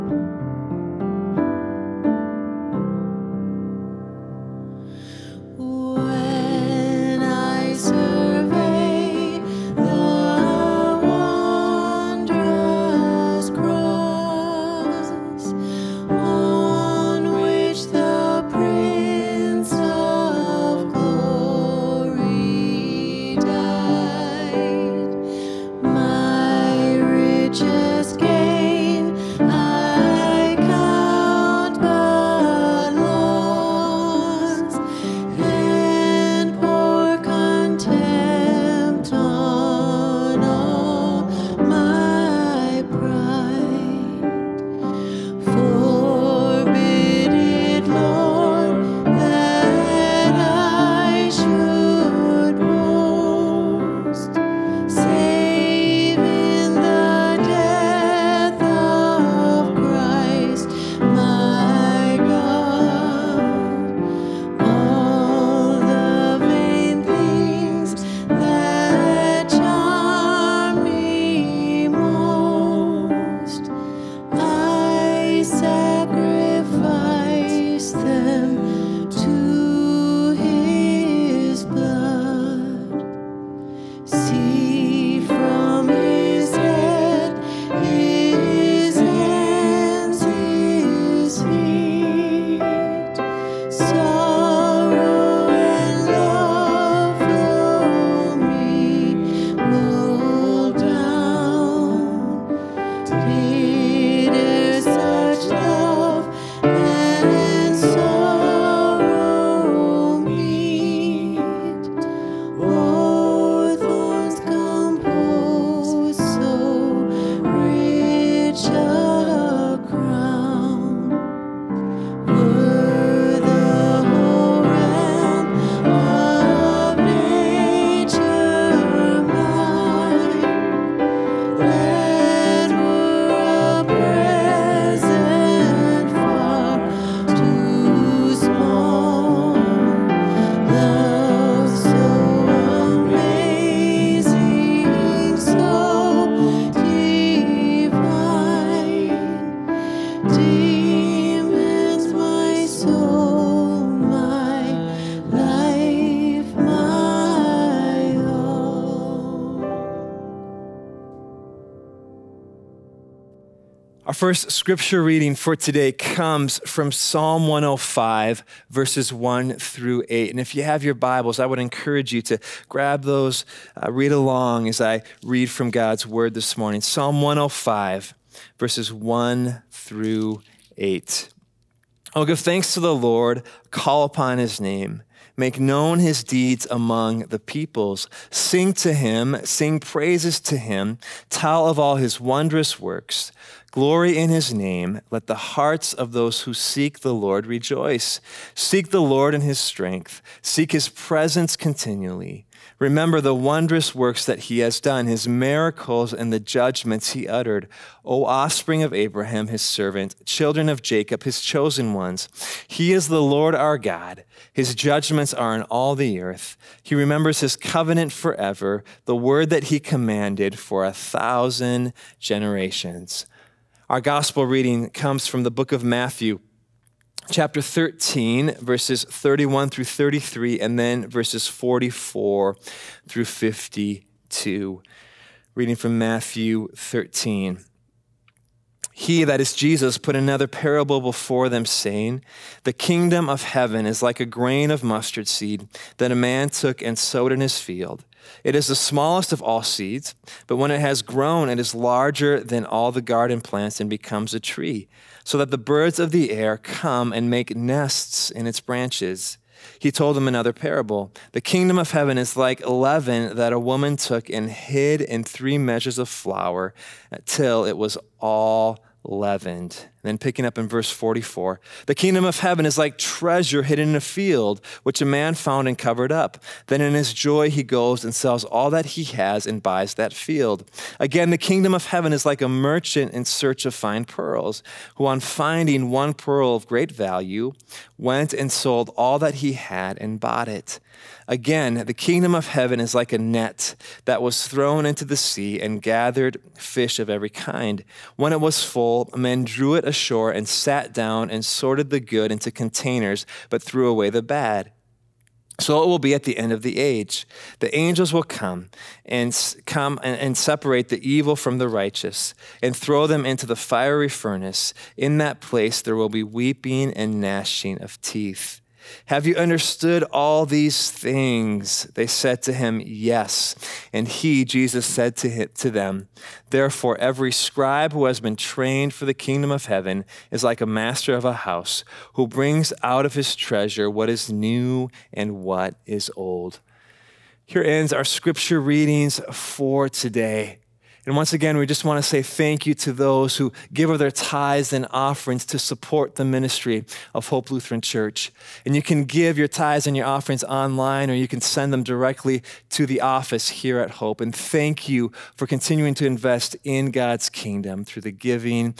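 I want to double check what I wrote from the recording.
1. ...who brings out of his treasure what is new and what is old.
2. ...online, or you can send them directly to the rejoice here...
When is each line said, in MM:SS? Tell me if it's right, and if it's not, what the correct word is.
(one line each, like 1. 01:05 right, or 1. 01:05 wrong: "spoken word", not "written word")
1. 05:32 right
2. 05:50 wrong: "office", not "rejoice".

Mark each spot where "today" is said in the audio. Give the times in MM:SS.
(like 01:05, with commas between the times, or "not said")
02:45, 05:39.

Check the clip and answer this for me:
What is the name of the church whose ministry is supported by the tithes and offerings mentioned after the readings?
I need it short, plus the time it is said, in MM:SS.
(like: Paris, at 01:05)
Hope Lutheran Church, at 05:47.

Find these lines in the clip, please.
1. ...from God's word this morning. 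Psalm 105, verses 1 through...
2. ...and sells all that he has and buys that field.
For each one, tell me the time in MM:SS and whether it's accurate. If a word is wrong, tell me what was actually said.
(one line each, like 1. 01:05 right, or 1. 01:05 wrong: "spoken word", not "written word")
1. 02:55 right
2. 04:38 right.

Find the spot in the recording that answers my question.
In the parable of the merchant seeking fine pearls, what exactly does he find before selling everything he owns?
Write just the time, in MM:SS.
04:45.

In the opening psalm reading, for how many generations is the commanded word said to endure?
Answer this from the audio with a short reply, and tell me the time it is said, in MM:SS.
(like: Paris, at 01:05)
1000, at 03:40.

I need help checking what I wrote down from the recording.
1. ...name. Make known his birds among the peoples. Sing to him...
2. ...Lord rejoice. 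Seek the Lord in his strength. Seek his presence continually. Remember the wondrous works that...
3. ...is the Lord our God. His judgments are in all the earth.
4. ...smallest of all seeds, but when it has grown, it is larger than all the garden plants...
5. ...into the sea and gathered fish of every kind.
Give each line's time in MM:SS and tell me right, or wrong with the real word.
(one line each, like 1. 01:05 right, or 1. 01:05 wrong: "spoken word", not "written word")
1. 03:04 wrong: "deeds", not "birds"
2. 03:17 right
3. 03:32 right
4. 04:08 right
5. 04:54 right.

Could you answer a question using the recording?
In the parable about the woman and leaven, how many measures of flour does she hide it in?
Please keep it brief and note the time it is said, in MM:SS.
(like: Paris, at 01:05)
3, at 04:25.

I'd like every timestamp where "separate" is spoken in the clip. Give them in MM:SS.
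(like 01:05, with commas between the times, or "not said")
05:10.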